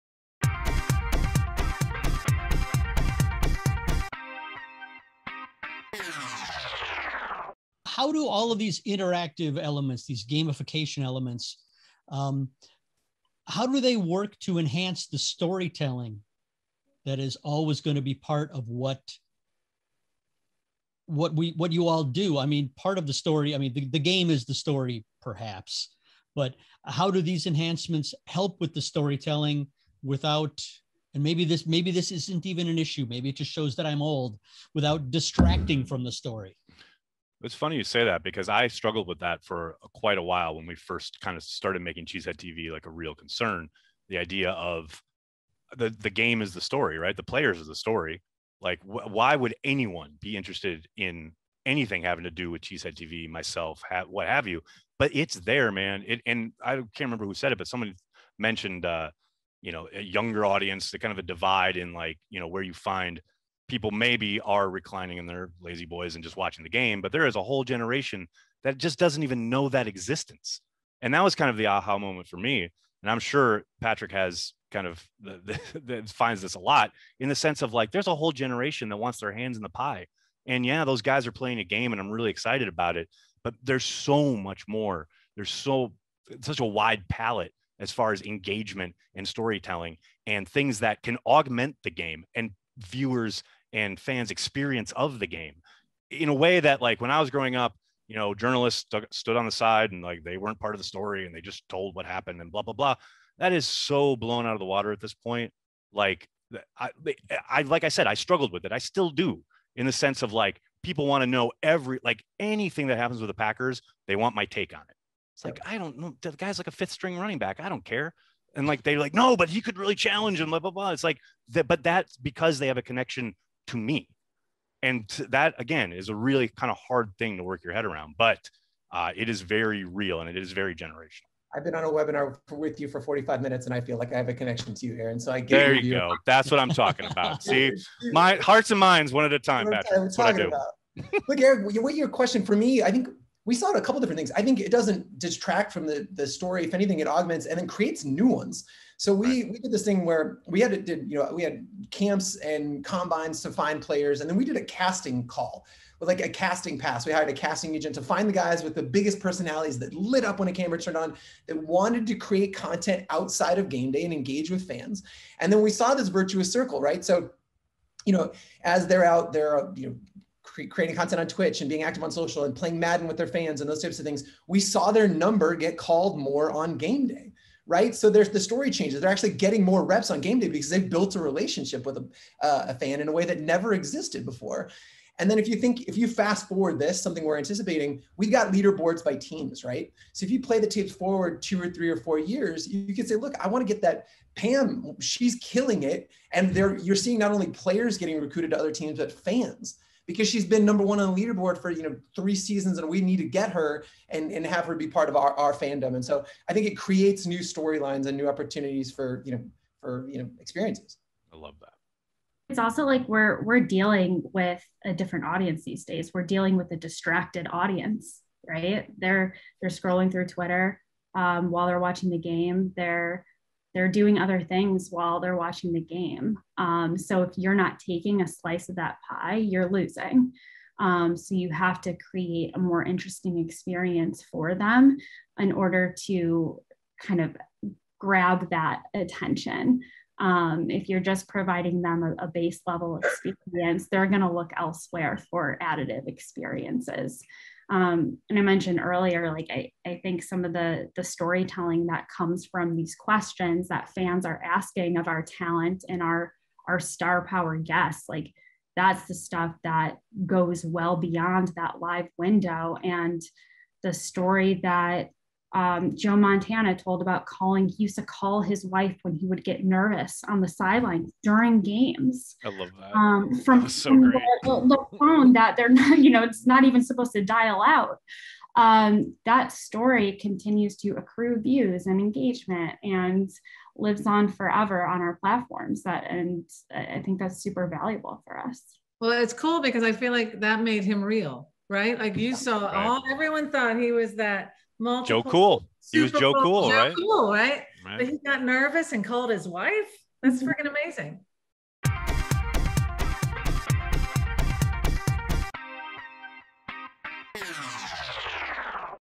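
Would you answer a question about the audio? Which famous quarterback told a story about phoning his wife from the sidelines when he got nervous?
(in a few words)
Joe Montana.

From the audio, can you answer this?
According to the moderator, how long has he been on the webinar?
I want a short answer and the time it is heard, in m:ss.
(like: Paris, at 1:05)
45 minutes, at 2:13.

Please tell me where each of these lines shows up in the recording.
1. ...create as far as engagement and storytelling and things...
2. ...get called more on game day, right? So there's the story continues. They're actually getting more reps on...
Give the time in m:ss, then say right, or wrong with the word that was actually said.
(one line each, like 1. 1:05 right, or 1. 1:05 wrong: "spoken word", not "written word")
1. 1:27 wrong: "palette", not "create"
2. 2:55 wrong: "changes", not "continues".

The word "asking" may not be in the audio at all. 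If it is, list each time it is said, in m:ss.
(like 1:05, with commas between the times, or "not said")
4:14.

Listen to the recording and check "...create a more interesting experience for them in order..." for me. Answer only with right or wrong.
right.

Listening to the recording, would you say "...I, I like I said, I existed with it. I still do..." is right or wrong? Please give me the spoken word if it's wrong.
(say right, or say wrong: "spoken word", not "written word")
wrong: "struggled", not "existed".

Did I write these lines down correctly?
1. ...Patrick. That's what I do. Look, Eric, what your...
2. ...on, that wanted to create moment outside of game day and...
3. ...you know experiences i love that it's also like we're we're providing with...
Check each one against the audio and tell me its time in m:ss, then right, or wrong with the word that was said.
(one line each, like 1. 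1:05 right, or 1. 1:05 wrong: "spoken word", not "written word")
1. 2:19 right
2. 2:40 wrong: "content", not "moment"
3. 3:30 wrong: "dealing", not "providing".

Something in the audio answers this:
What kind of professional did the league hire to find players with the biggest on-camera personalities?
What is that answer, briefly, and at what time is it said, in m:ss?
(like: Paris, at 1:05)
A casting agent, at 2:37.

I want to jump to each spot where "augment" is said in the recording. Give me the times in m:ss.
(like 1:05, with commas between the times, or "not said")
1:31, 2:27.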